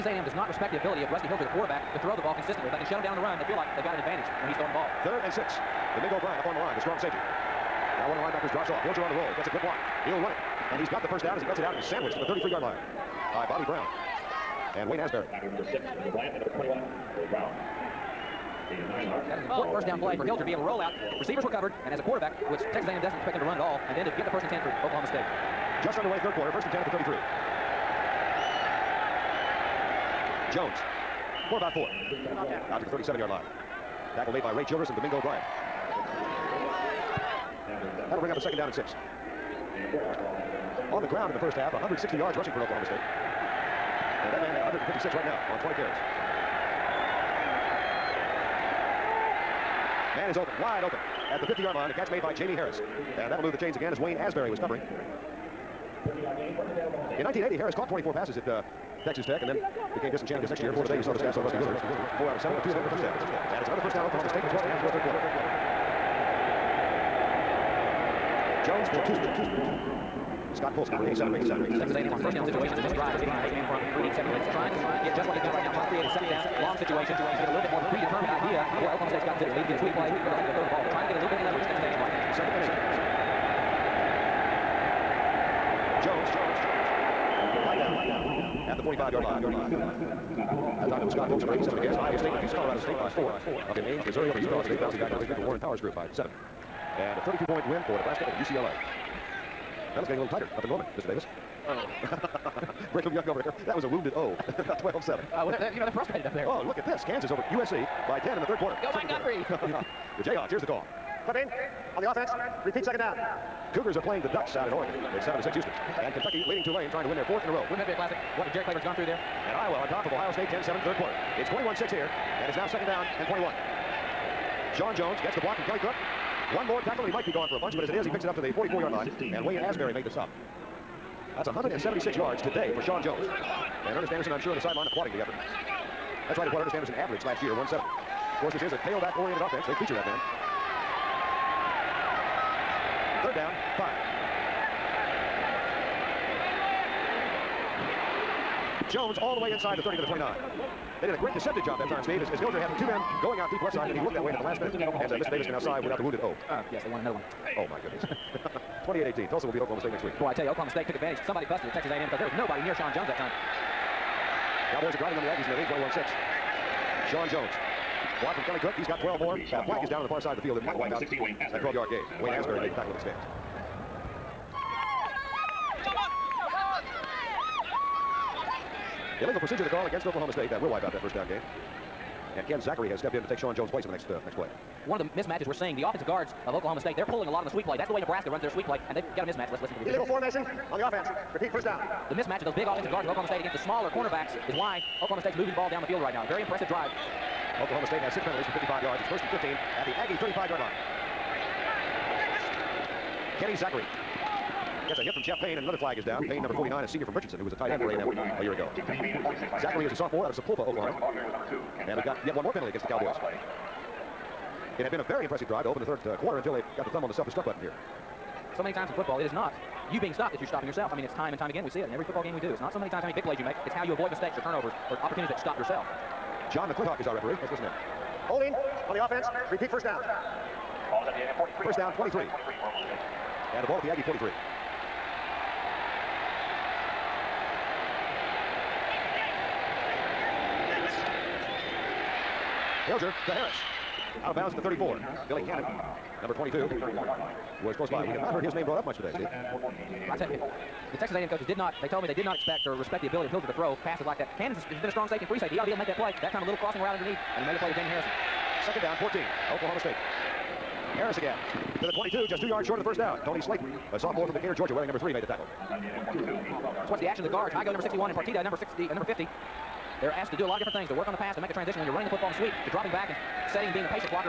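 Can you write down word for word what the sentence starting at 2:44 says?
Cowboys are driving on the Aggies, and they lead 21-6.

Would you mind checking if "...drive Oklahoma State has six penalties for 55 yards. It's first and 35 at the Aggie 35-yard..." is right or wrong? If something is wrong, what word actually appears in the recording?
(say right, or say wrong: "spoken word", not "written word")
wrong: "15", not "35".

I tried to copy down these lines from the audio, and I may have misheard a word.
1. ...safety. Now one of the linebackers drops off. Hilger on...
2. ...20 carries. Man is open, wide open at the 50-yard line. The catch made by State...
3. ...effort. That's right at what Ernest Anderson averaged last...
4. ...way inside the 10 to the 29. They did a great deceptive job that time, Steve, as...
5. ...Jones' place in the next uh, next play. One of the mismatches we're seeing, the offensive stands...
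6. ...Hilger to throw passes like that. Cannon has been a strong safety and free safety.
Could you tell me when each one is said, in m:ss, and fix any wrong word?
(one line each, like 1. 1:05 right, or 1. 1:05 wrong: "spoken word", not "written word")
1. 0:06 right
2. 0:45 wrong: "Jamie", not "State"
3. 2:15 right
4. 2:29 wrong: "30", not "10"
5. 3:03 wrong: "guards", not "stands"
6. 4:13 right.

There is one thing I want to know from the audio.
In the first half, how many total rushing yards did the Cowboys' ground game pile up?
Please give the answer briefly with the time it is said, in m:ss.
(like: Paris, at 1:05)
160, at 0:41.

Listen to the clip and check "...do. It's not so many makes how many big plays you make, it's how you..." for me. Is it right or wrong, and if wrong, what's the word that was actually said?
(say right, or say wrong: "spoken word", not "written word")
wrong: "times", not "makes".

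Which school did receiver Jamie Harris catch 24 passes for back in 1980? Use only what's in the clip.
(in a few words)
Texas Tech.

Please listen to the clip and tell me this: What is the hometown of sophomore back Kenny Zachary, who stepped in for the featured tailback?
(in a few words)
Sapulpa, Oklahoma.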